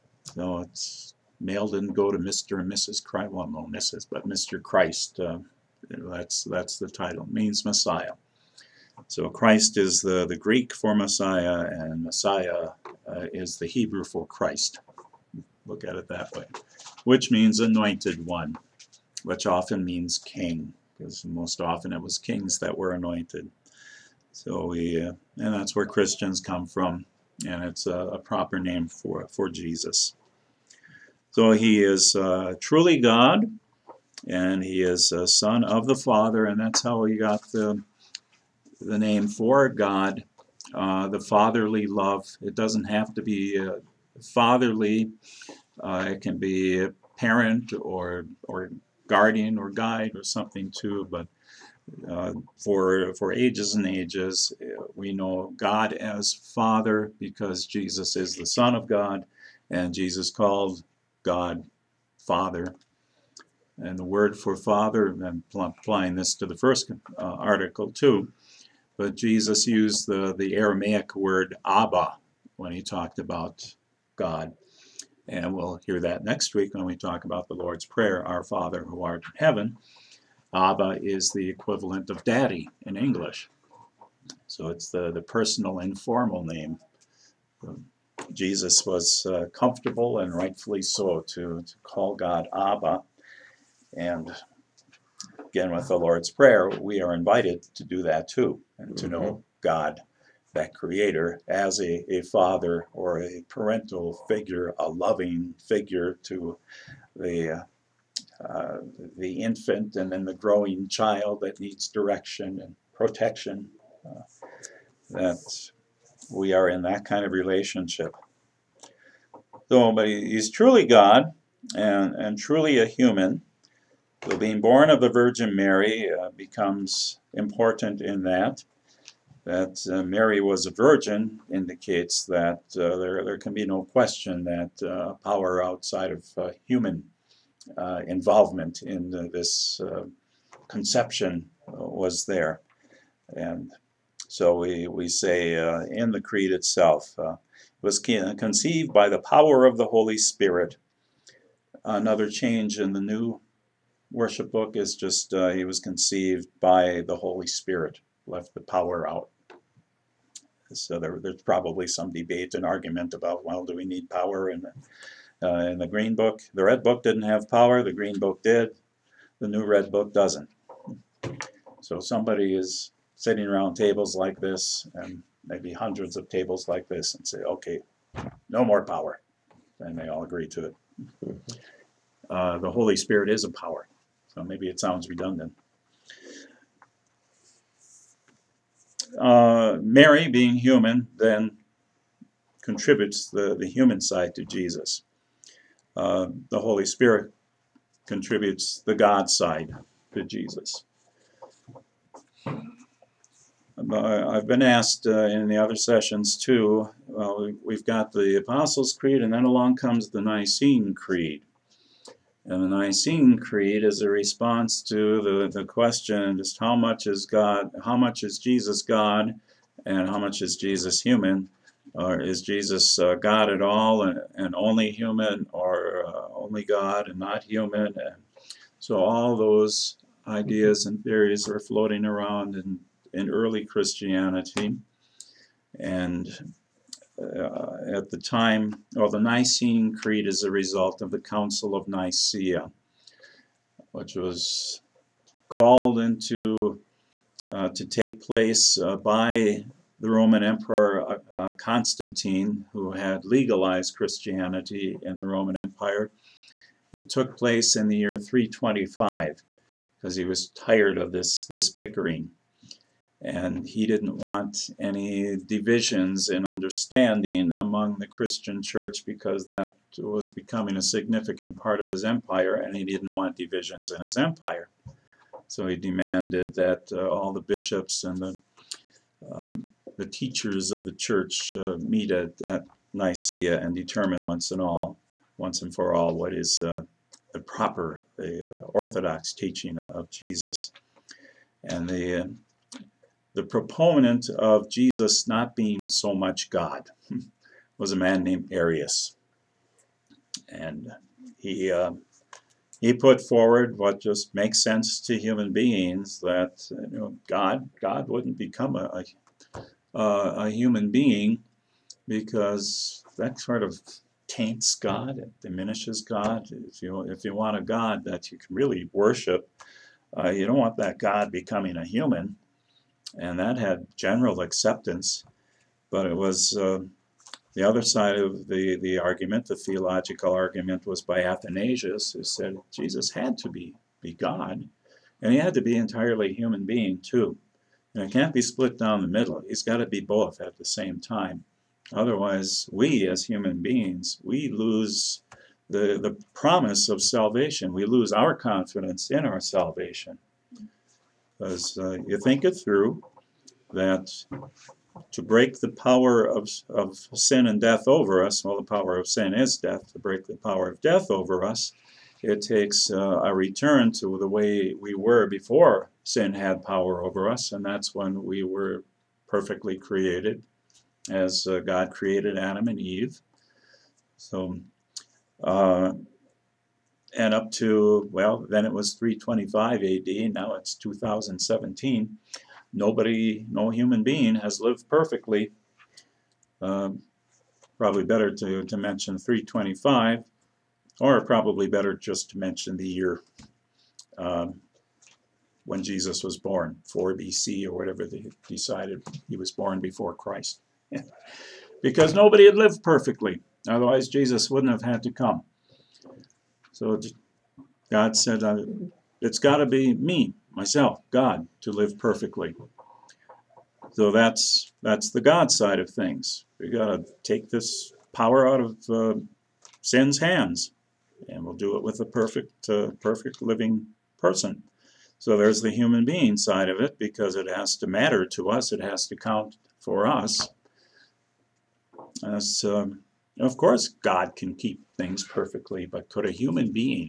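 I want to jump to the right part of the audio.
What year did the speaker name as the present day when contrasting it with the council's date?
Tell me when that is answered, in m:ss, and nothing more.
6:20.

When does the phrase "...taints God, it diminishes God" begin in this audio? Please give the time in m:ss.
5:14.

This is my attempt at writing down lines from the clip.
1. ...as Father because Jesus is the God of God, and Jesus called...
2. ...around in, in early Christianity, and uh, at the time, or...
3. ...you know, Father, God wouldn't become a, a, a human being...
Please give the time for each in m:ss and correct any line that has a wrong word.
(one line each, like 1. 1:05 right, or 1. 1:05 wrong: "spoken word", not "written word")
1. 0:55 wrong: "Son", not "God"
2. 3:52 right
3. 5:06 wrong: "God", not "Father".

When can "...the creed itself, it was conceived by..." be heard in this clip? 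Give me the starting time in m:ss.
2:26.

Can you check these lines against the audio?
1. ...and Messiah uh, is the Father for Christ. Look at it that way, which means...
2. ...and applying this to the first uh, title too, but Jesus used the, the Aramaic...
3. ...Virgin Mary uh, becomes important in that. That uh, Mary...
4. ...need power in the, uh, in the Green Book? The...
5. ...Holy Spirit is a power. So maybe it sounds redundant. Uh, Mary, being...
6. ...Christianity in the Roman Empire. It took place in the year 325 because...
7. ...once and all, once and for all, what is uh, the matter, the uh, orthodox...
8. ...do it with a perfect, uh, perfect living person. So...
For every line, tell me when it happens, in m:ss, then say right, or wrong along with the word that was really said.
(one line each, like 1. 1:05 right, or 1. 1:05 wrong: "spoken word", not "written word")
1. 0:11 wrong: "Hebrew", not "Father"
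2. 1:05 wrong: "article", not "title"
3. 2:05 right
4. 2:43 right
5. 3:02 right
6. 4:13 right
7. 4:44 wrong: "proper", not "matter"
8. 7:01 right.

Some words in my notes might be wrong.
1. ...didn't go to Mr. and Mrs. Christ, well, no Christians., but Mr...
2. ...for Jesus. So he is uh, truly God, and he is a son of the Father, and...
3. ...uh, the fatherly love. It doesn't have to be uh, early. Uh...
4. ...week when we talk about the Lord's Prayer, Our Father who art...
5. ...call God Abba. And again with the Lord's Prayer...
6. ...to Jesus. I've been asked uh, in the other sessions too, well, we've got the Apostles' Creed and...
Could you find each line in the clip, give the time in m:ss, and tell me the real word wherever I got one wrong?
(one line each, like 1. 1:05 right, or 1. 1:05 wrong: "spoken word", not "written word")
1. 0:01 wrong: "Mrs", not "Christians"
2. 0:29 right
3. 0:40 wrong: "fatherly", not "early"
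4. 1:16 right
5. 1:31 right
6. 3:20 right.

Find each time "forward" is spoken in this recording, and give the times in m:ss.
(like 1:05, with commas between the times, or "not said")
5:03.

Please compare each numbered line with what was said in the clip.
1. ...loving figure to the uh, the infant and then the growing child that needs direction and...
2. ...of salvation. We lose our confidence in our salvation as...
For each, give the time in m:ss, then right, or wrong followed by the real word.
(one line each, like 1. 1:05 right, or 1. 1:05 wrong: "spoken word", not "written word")
1. 1:44 right
2. 5:46 right.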